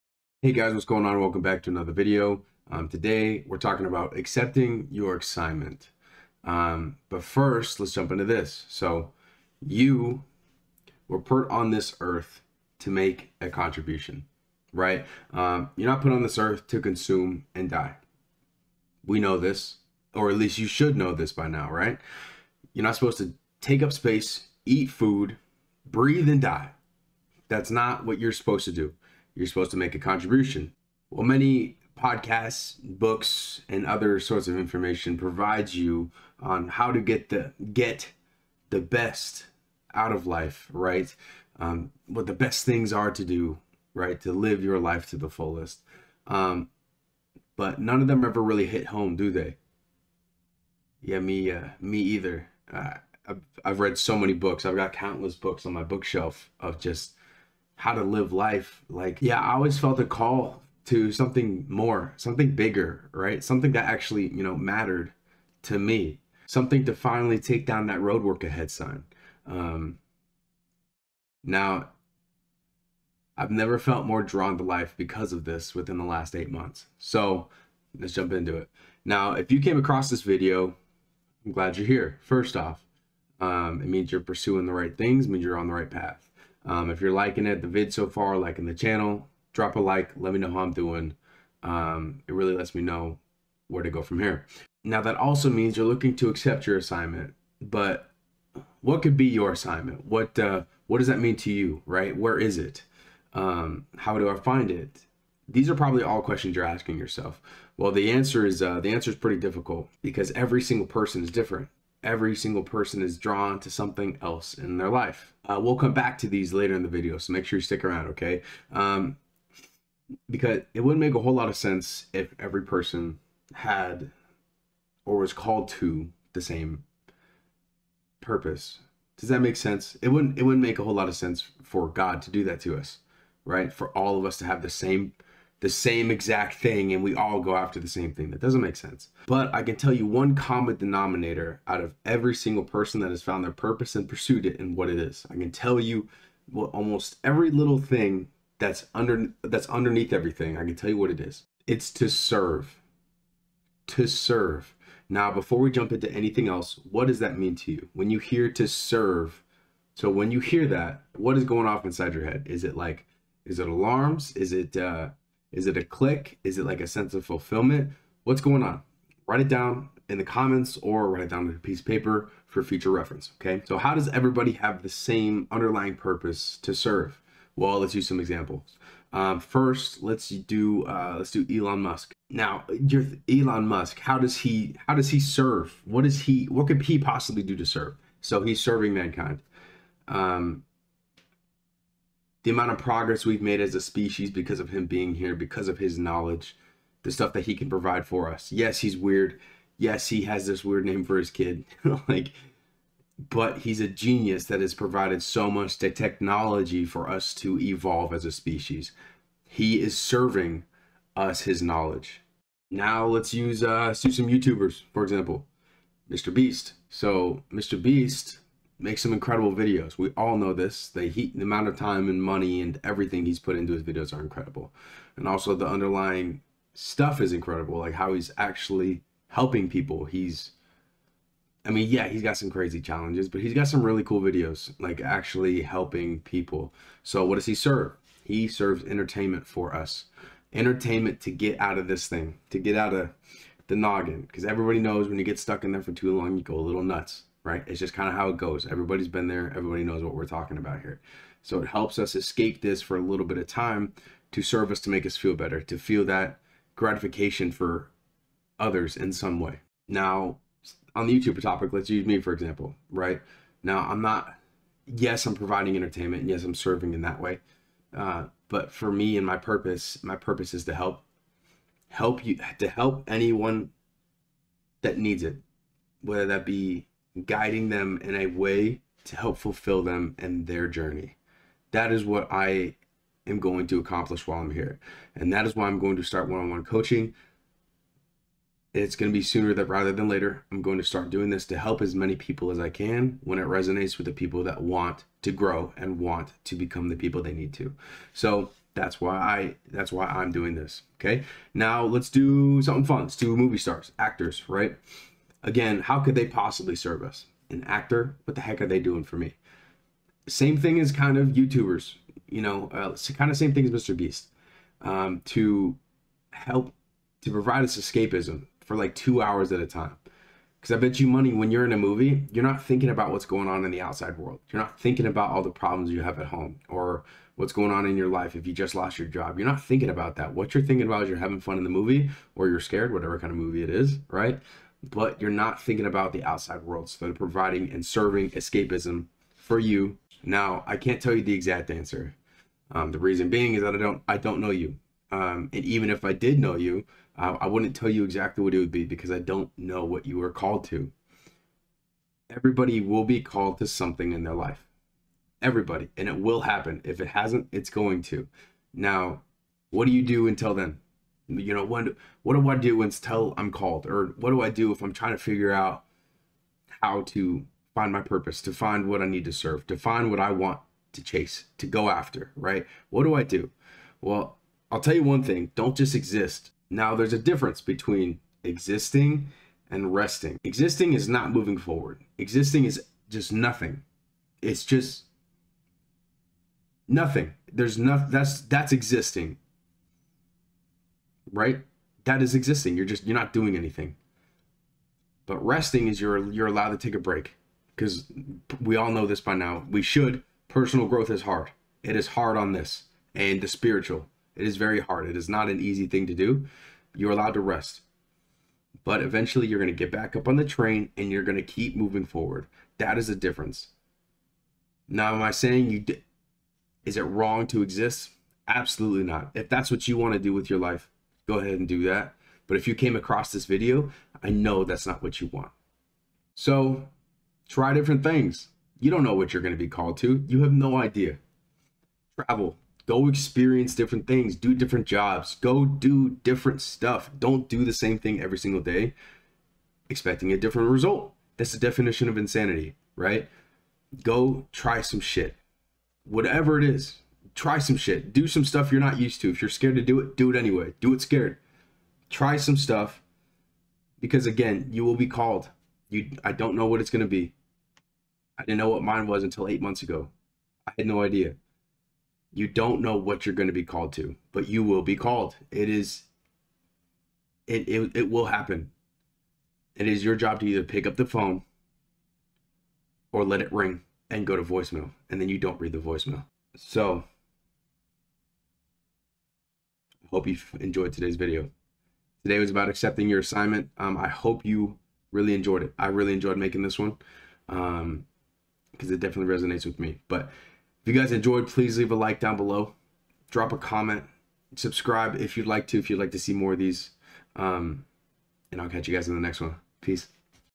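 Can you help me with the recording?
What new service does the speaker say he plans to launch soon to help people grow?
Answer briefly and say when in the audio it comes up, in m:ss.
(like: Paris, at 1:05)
One on one coaching, at 4:46.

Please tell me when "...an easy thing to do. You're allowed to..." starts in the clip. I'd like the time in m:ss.
6:45.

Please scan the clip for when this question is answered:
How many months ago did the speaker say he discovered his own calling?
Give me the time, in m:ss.
7:39.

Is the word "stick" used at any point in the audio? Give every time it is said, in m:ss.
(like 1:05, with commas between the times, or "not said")
1:57.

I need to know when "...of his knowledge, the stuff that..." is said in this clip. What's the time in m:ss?
3:15.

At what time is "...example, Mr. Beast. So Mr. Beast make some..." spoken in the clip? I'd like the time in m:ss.
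3:35.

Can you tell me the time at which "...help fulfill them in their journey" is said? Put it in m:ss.
4:39.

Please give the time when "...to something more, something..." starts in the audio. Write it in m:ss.
1:00.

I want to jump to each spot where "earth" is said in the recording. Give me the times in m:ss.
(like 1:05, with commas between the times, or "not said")
0:12, 0:16.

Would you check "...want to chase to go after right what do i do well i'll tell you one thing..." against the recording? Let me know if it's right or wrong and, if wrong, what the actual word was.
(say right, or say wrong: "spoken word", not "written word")
right.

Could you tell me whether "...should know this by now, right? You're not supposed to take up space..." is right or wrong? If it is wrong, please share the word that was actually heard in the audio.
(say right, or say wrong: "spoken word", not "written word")
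right.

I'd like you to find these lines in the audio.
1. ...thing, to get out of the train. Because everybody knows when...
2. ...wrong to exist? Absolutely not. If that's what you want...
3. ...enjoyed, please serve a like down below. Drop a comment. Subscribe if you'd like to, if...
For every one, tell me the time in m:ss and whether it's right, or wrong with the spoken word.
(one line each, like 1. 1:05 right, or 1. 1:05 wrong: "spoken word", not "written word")
1. 4:02 wrong: "noggin", not "train"
2. 6:57 right
3. 8:11 wrong: "leave", not "serve".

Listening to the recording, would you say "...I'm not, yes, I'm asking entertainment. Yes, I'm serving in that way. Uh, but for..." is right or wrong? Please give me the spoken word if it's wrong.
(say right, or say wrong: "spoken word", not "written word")
wrong: "providing", not "asking".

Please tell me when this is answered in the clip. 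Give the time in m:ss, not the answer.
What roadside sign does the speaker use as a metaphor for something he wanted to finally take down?
1:07.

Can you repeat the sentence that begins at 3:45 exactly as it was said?
And also the underlying stuff is incredible, like how he's actually helping people.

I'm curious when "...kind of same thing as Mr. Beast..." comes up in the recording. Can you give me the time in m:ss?
5:13.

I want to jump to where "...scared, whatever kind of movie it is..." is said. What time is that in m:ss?
5:32.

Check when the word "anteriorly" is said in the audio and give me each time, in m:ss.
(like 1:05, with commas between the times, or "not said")
not said.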